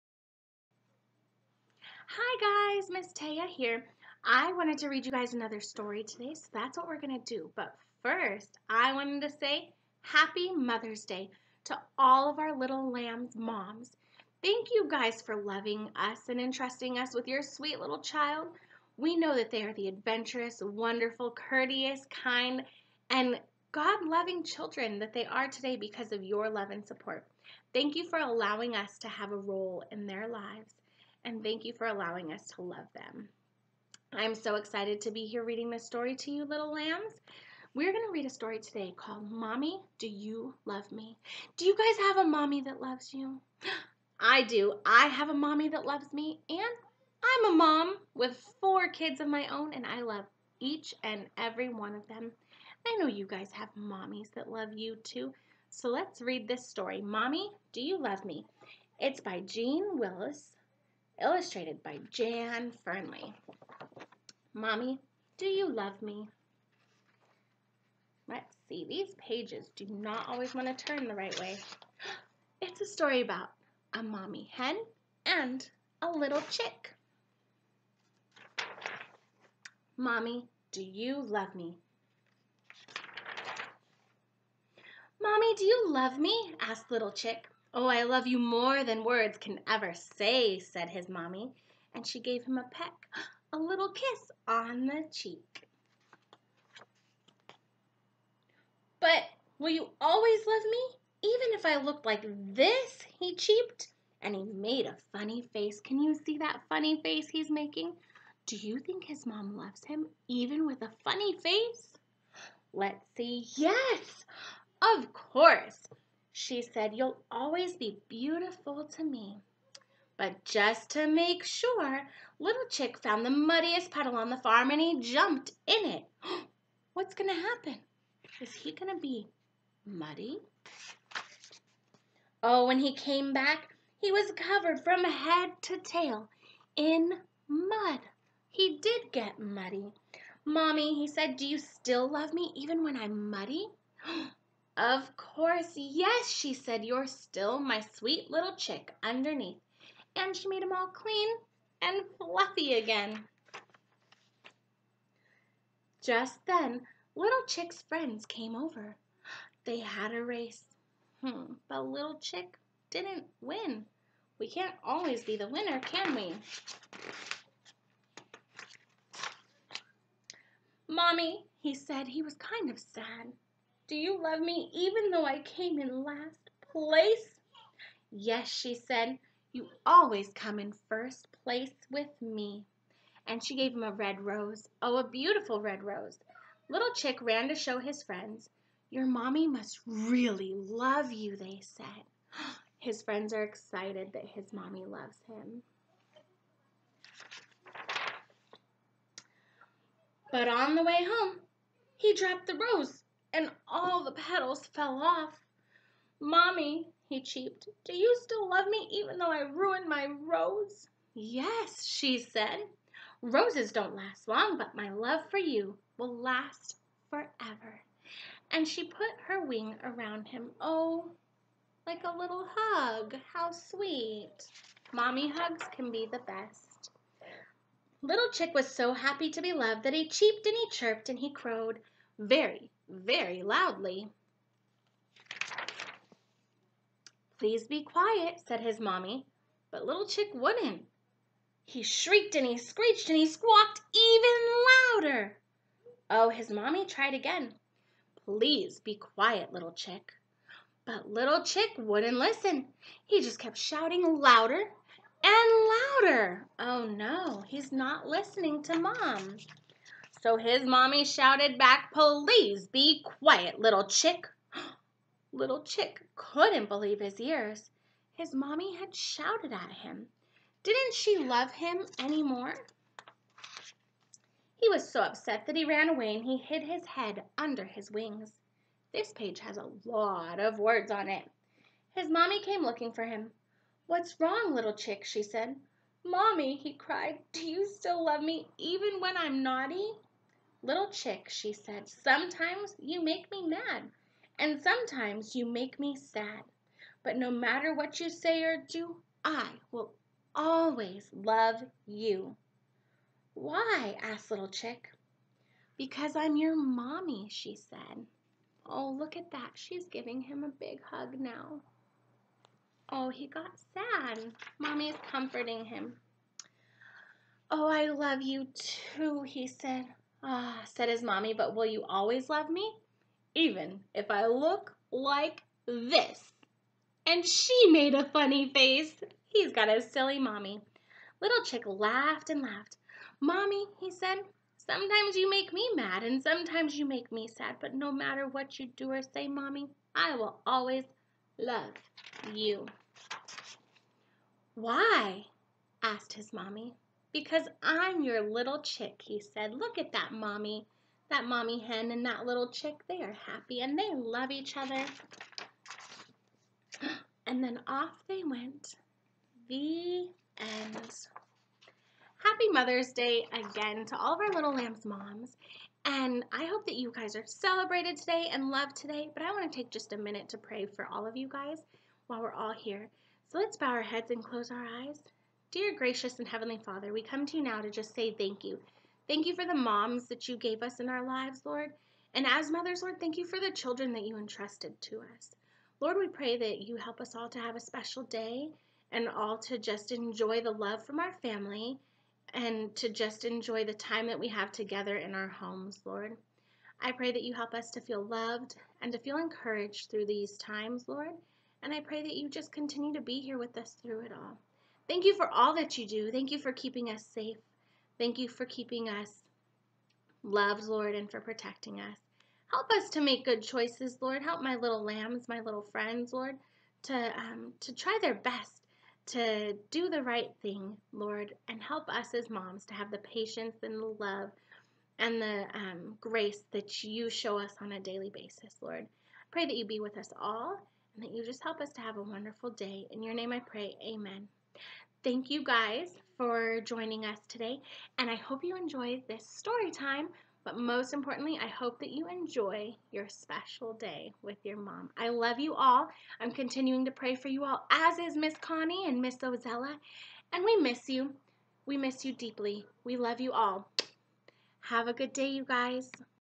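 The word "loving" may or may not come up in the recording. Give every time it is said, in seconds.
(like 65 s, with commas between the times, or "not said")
15 s, 24 s.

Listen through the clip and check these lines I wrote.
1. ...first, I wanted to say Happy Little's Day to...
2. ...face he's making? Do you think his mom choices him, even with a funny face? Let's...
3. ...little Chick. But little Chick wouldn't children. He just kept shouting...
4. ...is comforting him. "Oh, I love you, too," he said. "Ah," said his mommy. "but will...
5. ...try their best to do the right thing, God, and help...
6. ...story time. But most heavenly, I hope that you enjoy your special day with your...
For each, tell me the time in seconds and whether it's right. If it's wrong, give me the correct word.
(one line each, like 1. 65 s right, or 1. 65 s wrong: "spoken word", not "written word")
1. 8 s wrong: "Mother", not "Little"
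2. 107 s wrong: "loves", not "choices"
3. 249 s wrong: "listen", not "children"
4. 314 s right
5. 417 s wrong: "Lord", not "God"
6. 439 s wrong: "importantly", not "heavenly".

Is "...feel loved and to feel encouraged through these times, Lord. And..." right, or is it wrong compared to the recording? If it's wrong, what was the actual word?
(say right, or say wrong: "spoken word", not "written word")
right.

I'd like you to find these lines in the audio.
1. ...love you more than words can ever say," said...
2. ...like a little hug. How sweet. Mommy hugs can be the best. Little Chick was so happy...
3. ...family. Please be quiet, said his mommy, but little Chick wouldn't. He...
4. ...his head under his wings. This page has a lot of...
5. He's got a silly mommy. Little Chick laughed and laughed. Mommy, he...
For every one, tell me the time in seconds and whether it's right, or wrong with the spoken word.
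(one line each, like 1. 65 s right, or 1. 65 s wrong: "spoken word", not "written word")
1. 88 s right
2. 221 s right
3. 233 s wrong: "loudly", not "family"
4. 276 s right
5. 329 s right.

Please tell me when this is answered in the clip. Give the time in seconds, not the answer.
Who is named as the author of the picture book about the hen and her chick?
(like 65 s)
59 s.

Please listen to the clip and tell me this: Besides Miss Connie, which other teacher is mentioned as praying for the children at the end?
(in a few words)
Miss Ozella.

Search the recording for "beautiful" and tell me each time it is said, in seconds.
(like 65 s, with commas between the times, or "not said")
118 s, 185 s.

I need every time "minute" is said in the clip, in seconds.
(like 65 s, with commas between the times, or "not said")
369 s.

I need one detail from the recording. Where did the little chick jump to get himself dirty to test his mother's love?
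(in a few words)
The muddiest puddle.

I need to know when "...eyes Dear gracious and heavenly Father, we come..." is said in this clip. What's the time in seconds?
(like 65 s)
374 s.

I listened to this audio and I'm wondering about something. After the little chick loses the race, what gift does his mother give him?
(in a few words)
A red rose.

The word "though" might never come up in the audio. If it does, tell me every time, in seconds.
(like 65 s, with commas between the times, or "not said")
175 s, 209 s.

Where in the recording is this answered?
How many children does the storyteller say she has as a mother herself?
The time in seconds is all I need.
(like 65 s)
48 s.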